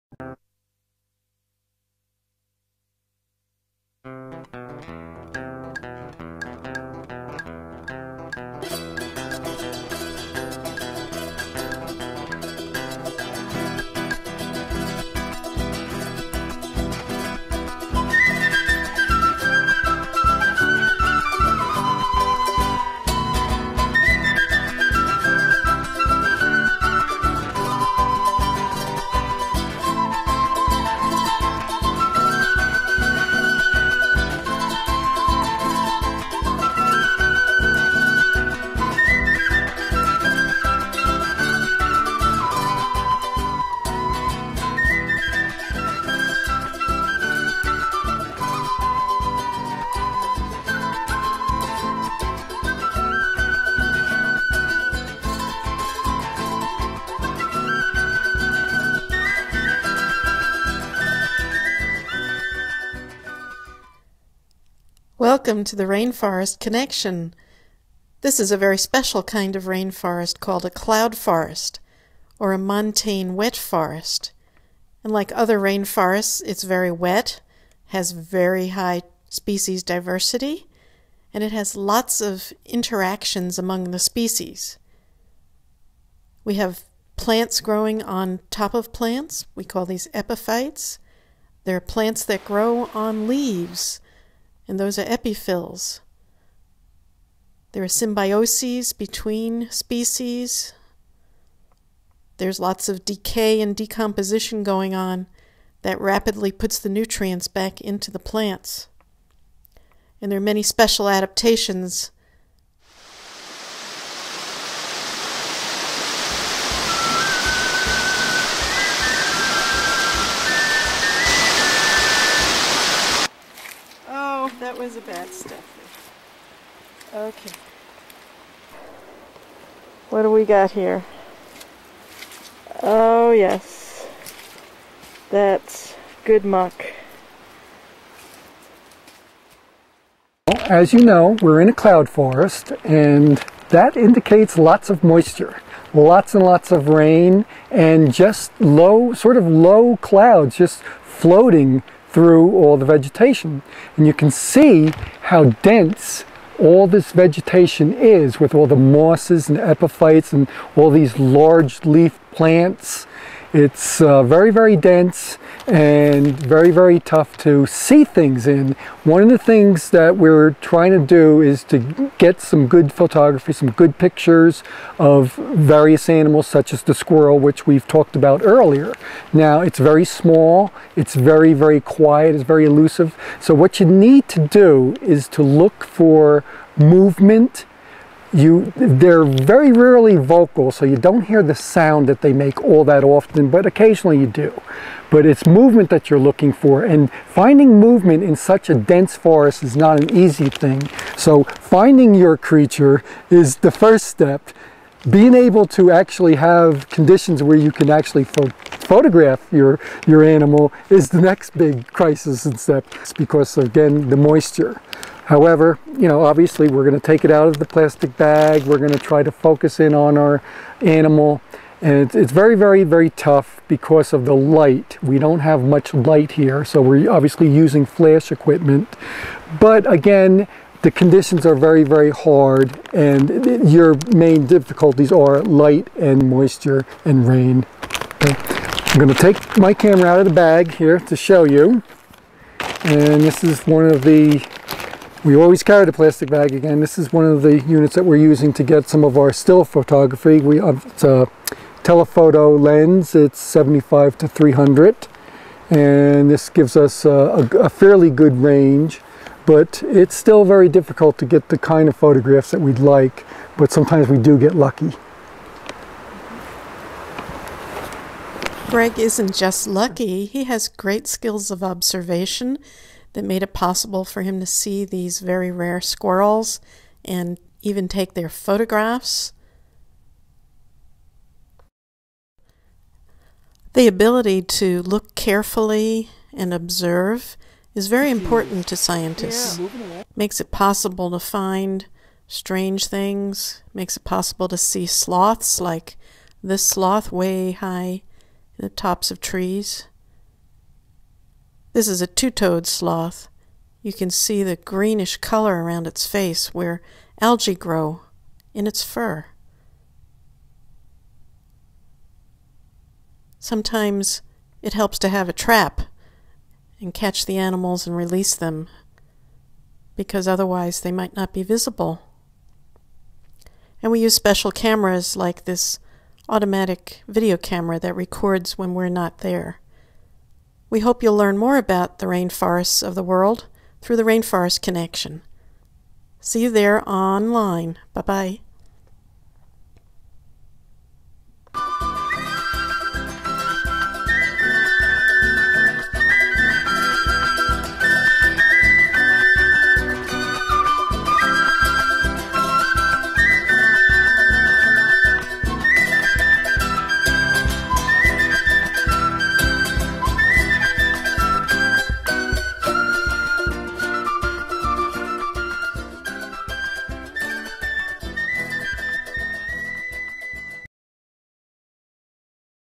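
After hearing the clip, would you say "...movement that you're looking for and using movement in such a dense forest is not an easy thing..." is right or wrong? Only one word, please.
wrong.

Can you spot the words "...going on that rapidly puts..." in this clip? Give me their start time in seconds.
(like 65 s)
104 s.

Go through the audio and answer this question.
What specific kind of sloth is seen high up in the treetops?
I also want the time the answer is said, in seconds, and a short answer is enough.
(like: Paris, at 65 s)
two-toed sloth, at 302 s.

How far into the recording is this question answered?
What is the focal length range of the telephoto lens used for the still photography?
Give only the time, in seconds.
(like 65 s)
253 s.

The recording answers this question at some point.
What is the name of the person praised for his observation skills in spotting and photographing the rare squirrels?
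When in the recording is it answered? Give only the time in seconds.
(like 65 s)
268 s.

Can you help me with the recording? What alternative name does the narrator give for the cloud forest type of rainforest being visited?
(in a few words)
montane wet forest.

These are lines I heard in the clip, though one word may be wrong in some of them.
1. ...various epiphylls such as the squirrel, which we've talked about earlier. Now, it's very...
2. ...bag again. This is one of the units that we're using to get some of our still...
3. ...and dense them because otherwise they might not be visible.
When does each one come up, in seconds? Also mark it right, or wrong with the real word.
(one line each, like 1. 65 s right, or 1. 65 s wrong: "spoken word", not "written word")
1. 175 s wrong: "animals", not "epiphylls"
2. 246 s right
3. 317 s wrong: "release", not "dense".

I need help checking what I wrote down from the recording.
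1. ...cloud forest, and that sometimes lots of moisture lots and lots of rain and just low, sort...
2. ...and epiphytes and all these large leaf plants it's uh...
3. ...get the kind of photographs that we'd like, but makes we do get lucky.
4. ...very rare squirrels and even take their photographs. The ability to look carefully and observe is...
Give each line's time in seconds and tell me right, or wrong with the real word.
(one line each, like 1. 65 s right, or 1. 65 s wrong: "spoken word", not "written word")
1. 141 s wrong: "indicates", not "sometimes"
2. 159 s right
3. 261 s wrong: "sometimes", not "makes"
4. 275 s right.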